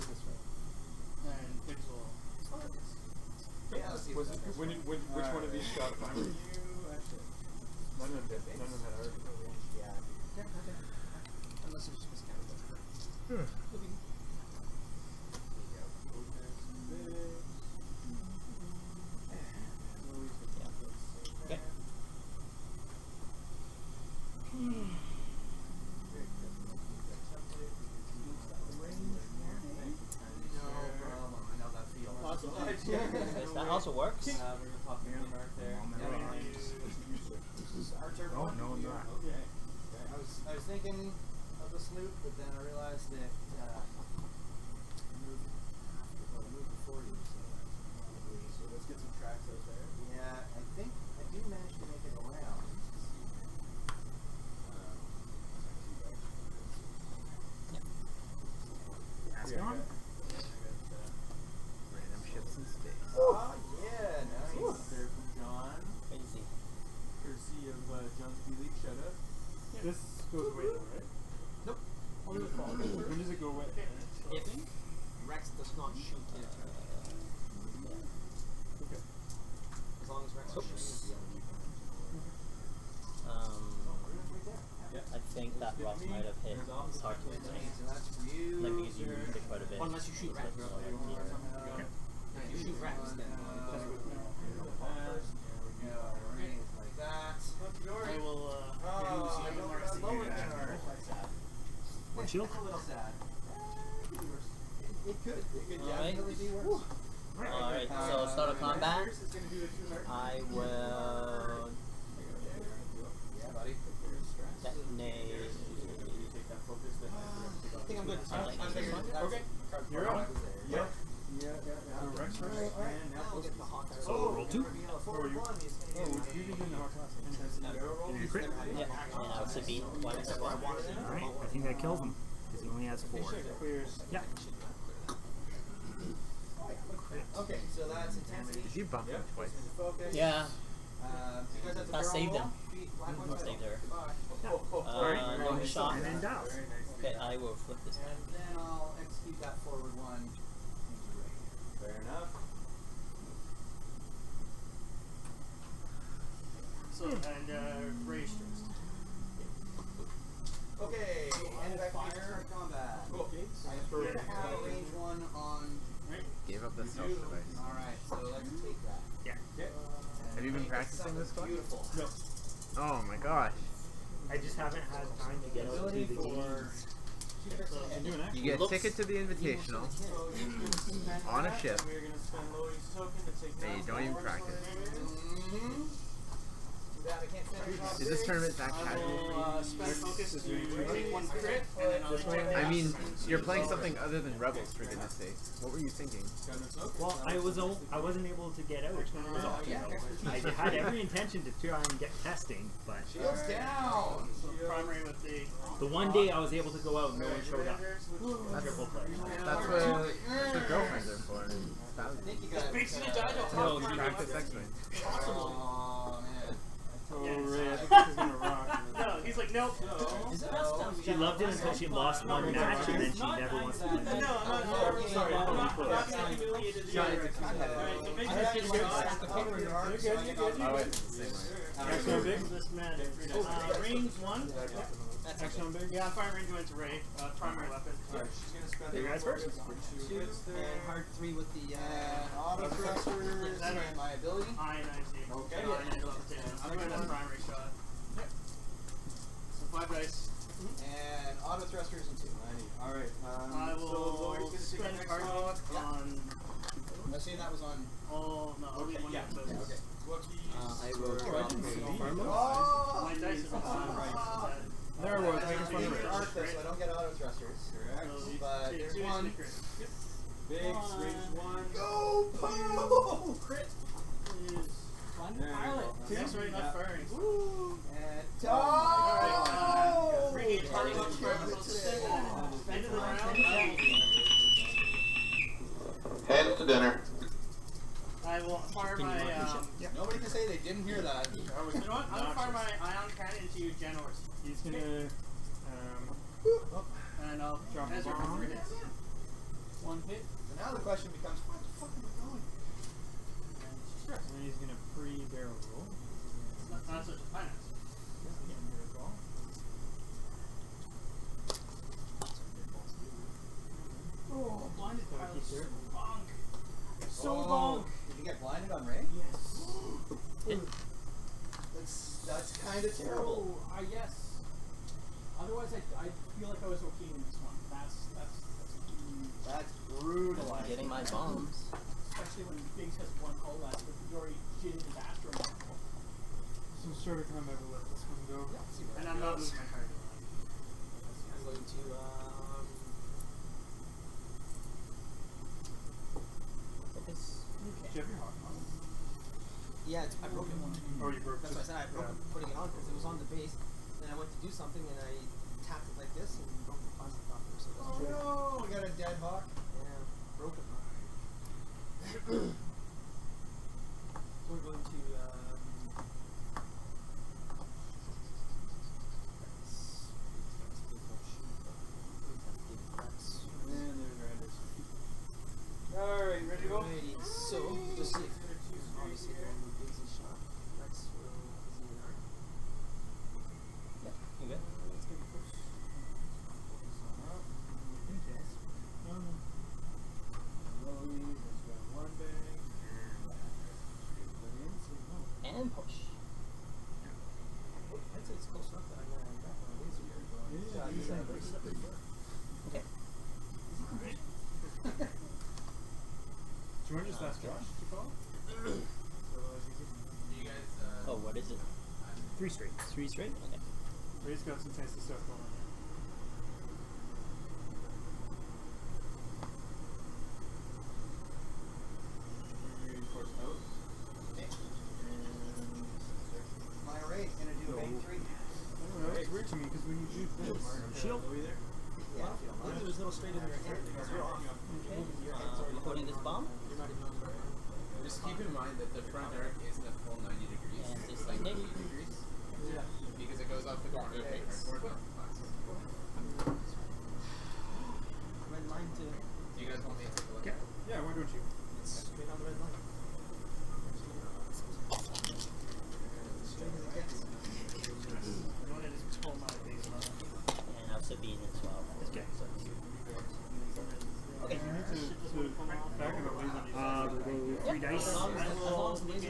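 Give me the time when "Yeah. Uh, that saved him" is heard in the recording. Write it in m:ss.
2:20.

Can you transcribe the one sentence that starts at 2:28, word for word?
then I'll execute that forward one Fair enough.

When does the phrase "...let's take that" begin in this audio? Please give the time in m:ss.
2:48.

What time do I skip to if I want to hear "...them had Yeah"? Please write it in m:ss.
0:08.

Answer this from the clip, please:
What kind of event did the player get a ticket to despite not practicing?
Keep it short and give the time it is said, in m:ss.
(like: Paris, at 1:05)
the Invitational, at 2:59.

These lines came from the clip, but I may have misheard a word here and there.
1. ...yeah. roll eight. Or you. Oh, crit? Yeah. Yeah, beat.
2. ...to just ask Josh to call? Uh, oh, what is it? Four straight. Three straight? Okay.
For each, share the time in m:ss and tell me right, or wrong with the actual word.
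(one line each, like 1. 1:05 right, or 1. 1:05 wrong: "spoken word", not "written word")
1. 2:02 wrong: "two", not "eight"
2. 6:47 wrong: "Three", not "Four".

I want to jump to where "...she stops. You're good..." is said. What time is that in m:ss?
3:48.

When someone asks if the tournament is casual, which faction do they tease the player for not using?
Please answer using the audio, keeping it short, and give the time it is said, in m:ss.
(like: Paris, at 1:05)
Rebels, at 3:14.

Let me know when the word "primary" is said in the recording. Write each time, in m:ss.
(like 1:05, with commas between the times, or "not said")
0:05, 3:57, 4:07.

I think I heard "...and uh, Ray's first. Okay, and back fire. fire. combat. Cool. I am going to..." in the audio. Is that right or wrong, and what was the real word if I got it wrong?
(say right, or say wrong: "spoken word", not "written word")
right.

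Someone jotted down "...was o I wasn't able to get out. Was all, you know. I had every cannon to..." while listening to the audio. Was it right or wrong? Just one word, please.
wrong.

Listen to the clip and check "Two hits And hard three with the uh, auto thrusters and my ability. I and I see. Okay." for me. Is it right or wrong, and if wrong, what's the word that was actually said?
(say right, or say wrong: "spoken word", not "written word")
right.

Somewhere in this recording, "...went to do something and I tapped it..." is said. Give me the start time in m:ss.
5:54.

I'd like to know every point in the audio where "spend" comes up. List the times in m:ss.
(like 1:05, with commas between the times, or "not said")
3:58, 4:14.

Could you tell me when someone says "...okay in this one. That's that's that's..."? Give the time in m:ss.
5:26.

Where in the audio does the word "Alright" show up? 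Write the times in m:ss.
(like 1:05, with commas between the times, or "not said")
1:47, 2:09, 2:47, 3:46, 3:58, 4:12.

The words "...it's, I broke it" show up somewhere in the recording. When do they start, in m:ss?
5:50.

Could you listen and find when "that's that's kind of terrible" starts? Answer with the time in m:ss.
5:21.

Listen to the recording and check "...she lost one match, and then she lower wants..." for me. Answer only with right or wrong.
wrong.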